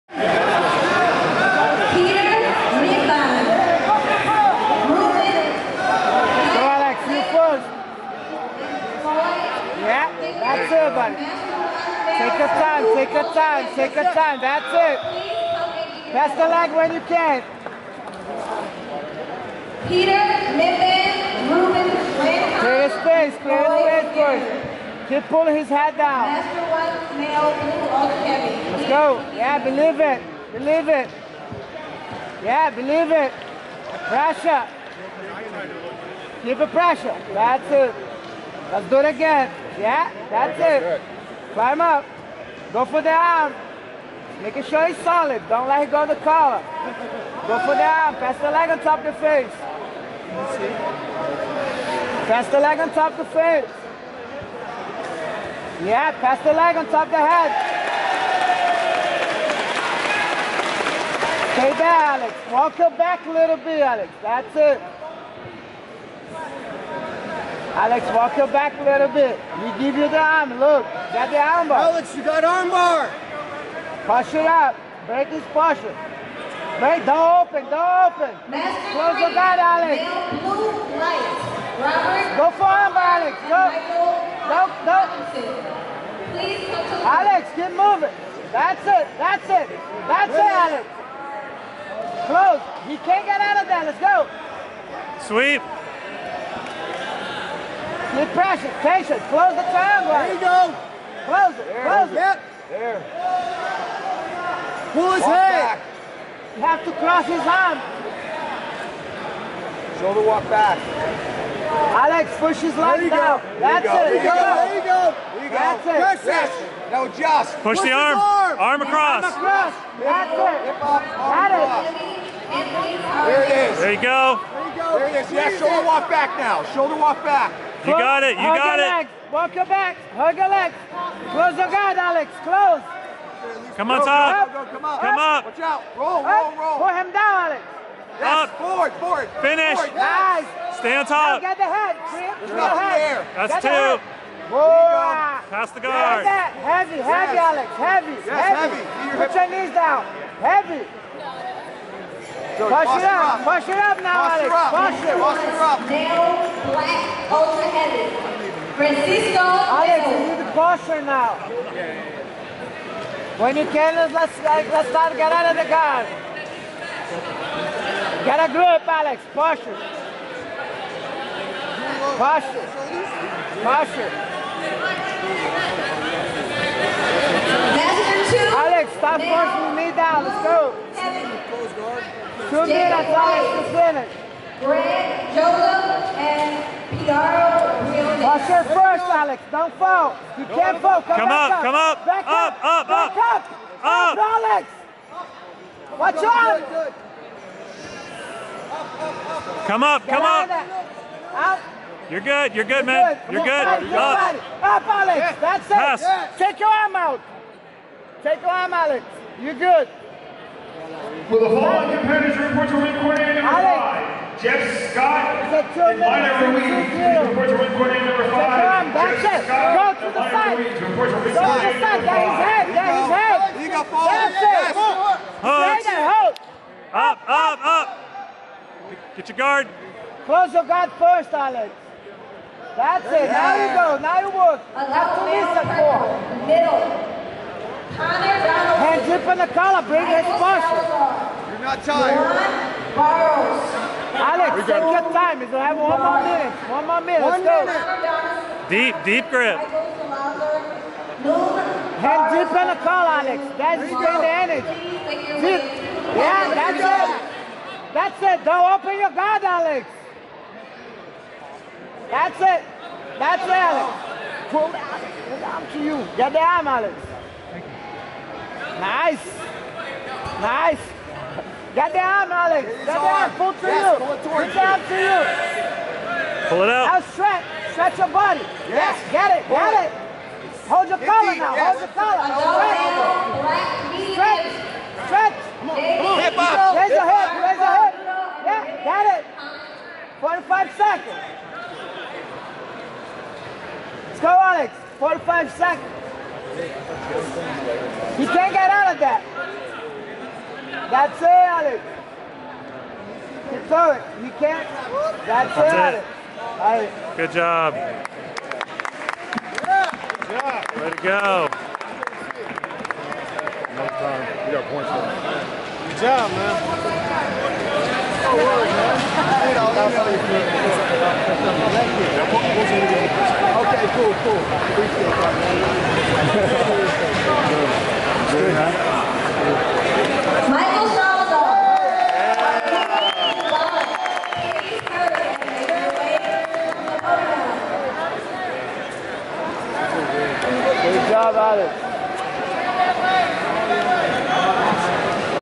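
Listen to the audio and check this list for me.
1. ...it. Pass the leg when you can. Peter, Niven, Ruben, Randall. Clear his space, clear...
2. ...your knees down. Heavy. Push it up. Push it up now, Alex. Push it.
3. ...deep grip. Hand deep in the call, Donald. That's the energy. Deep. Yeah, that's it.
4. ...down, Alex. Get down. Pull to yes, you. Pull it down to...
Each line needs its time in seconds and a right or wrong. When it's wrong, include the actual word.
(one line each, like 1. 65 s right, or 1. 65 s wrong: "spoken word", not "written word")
1. 14 s right
2. 149 s right
3. 249 s wrong: "Alex", not "Donald"
4. 271 s right.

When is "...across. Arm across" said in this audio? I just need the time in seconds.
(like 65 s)
118 s.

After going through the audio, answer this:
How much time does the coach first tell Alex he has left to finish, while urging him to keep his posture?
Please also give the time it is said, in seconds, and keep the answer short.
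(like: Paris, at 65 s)
2 minutes, at 182 s.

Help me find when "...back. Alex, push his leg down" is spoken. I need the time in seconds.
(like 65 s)
110 s.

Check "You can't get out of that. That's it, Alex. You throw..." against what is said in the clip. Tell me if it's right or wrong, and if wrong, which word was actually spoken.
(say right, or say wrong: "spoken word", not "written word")
right.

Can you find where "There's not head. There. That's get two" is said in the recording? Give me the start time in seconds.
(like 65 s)
142 s.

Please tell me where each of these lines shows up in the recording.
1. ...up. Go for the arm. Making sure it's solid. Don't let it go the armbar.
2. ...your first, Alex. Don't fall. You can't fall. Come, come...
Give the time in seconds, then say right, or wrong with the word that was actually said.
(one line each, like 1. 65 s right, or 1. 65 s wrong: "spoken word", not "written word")
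1. 41 s wrong: "collar", not "armbar"
2. 188 s right.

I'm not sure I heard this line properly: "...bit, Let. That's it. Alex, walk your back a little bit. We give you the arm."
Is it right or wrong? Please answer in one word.
wrong.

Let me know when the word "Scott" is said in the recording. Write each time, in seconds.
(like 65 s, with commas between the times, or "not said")
214 s, 219 s.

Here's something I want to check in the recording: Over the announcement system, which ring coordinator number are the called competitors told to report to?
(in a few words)
5.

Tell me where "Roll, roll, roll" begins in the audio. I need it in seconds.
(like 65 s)
135 s.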